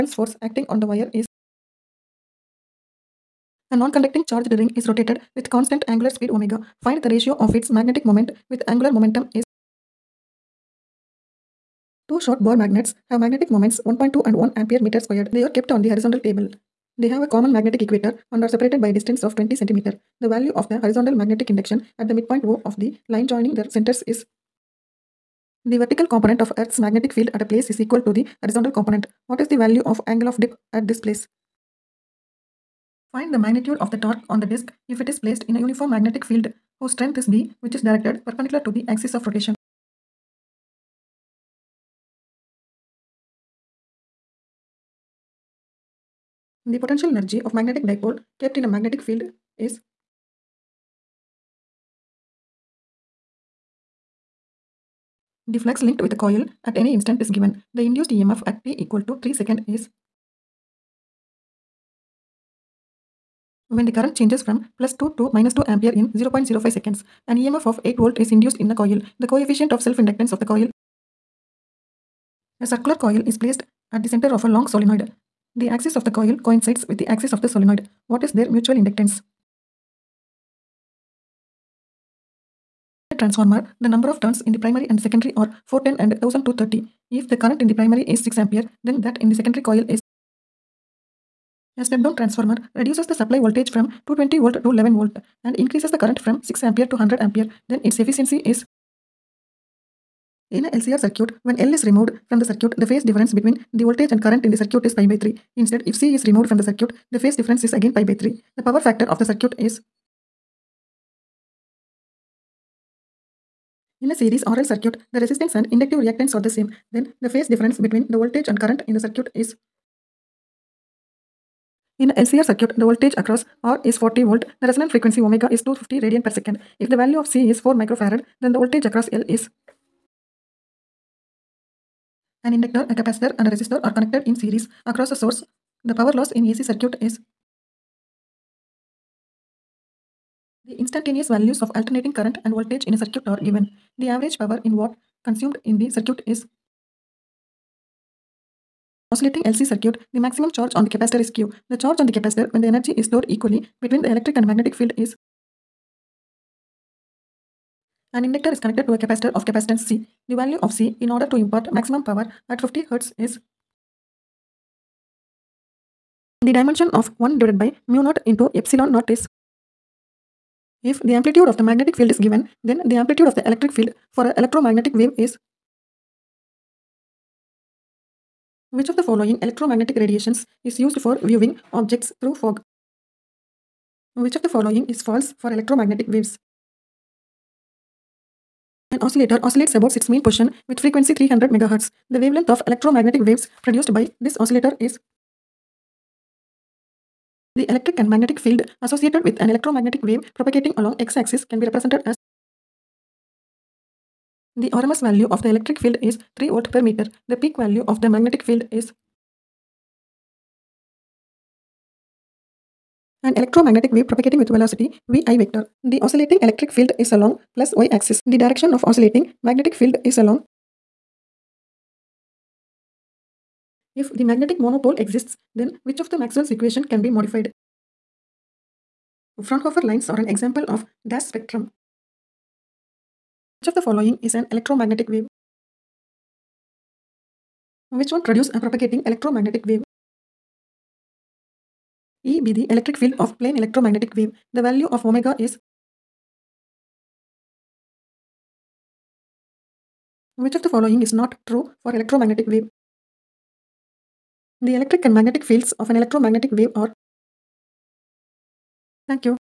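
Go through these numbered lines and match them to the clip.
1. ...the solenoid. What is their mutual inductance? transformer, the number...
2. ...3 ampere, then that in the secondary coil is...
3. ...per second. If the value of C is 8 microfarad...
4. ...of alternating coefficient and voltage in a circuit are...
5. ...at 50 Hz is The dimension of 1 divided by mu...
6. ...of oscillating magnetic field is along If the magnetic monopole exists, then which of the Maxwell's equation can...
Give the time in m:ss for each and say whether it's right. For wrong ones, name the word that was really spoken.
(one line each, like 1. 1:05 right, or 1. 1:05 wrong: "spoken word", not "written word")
1. 1:17 right
2. 1:28 wrong: "6", not "3"
3. 2:06 wrong: "4", not "8"
4. 2:21 wrong: "current", not "coefficient"
5. 2:42 right
6. 3:38 right.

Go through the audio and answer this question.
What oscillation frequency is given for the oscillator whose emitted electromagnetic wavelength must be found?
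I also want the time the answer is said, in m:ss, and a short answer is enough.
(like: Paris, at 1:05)
300 MHz, at 3:11.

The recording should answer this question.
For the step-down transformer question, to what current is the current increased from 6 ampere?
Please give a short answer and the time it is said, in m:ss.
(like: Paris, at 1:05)
100 ampere, at 1:37.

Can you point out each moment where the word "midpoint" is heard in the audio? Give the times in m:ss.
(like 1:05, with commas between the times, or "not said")
0:22.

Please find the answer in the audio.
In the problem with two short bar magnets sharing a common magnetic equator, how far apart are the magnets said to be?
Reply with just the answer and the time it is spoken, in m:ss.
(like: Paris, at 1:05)
20 centimeter, at 0:19.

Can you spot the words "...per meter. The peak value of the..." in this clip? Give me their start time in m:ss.
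3:26.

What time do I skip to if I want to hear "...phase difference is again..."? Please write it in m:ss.
1:47.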